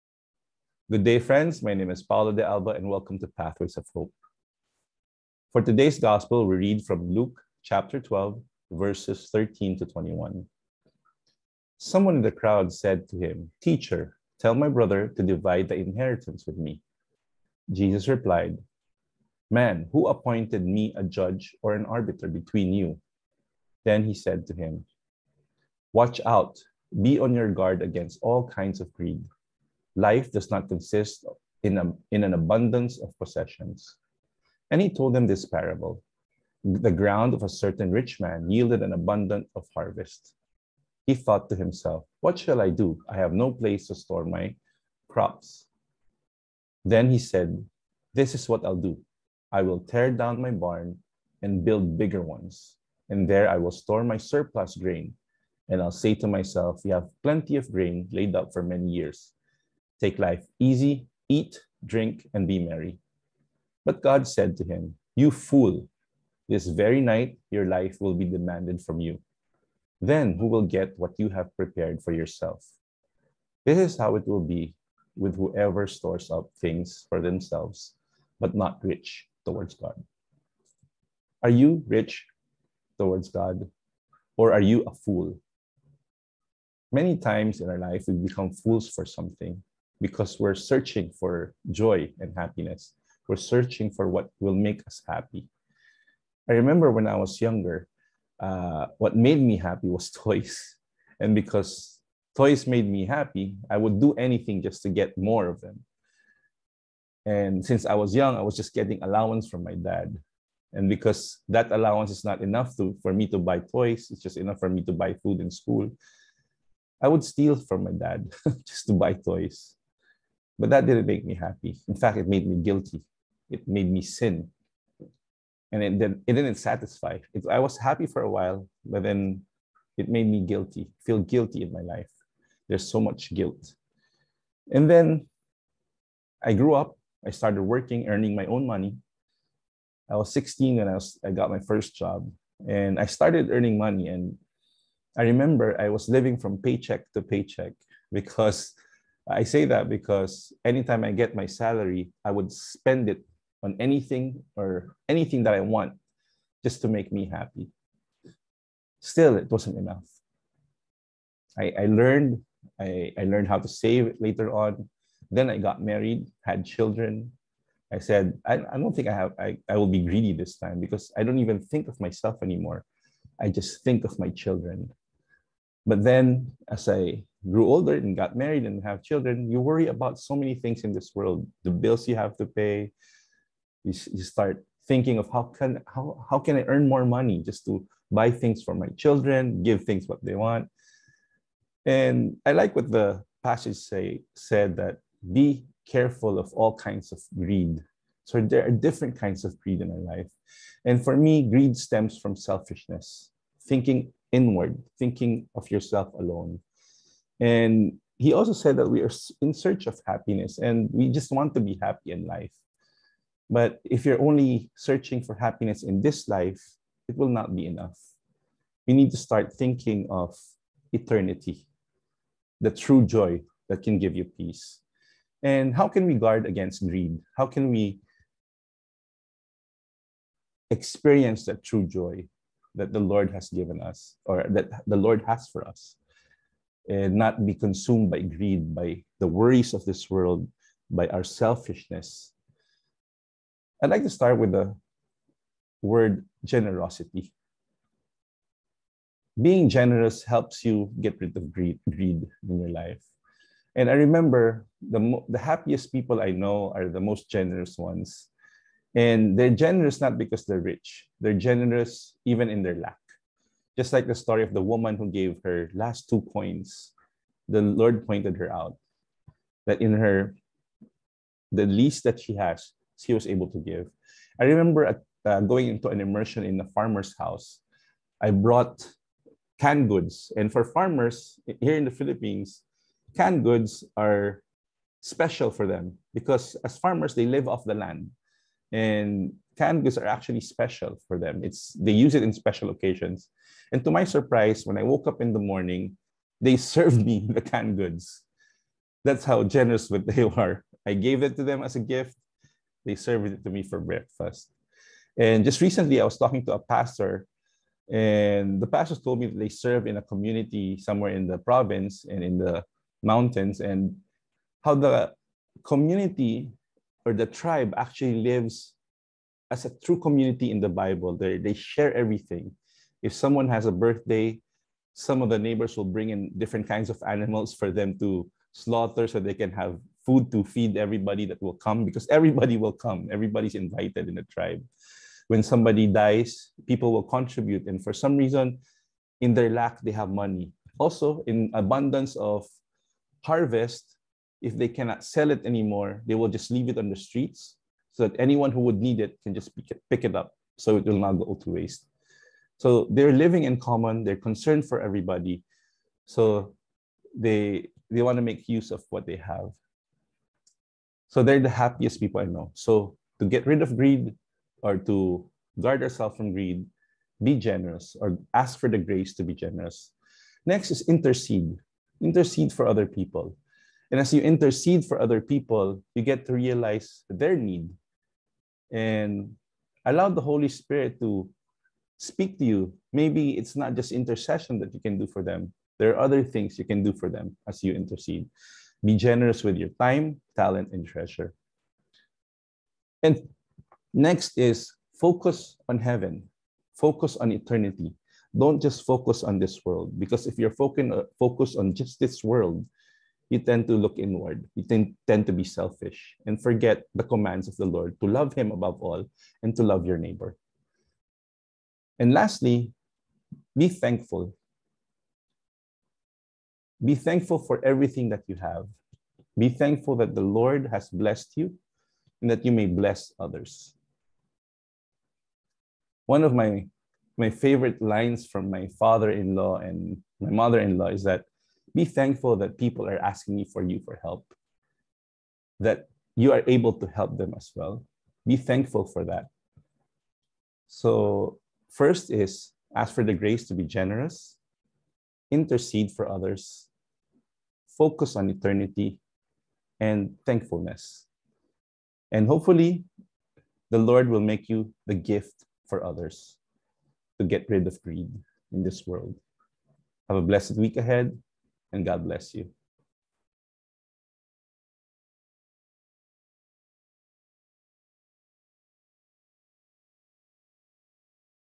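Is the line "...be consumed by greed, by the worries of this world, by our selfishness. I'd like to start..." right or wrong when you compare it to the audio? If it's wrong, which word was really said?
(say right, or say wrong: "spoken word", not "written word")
right.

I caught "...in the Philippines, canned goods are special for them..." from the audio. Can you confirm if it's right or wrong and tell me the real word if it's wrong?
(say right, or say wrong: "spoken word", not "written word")
right.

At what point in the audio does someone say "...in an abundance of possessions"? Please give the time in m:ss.
0:32.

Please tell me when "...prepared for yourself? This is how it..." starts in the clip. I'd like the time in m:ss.
1:11.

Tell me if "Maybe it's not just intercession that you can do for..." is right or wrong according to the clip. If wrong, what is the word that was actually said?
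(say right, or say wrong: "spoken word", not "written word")
right.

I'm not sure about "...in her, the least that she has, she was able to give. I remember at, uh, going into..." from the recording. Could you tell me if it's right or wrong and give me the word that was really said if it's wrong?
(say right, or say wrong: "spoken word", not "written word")
right.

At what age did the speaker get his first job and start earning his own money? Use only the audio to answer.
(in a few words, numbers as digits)
16.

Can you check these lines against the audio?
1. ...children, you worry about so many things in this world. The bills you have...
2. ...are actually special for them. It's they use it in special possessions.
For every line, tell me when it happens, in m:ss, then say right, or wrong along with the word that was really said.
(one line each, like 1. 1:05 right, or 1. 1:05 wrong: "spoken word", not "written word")
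1. 2:59 right
2. 4:49 wrong: "occasions", not "possessions".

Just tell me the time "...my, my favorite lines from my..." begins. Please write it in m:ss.
7:06.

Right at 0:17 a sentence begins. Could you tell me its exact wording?
Jesus replied, Man, who appointed me a judge or an arbiter between you?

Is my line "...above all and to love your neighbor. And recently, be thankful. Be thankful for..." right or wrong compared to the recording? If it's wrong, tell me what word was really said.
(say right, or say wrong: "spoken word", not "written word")
wrong: "lastly", not "recently".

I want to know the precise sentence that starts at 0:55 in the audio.
And I'll say to myself, You have plenty of grain laid up for many years.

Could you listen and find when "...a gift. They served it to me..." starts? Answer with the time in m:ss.
5:01.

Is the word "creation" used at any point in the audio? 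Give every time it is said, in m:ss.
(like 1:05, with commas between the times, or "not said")
not said.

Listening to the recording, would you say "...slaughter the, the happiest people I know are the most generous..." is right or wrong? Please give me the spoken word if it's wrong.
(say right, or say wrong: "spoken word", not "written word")
wrong: "remember", not "slaughter".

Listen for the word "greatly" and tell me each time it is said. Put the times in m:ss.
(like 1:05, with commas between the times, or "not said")
not said.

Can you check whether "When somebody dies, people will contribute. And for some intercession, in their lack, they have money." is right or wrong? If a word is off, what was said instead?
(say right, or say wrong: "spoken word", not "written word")
wrong: "reason", not "intercession".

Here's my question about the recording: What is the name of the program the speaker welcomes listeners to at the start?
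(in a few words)
Pathways of Hope.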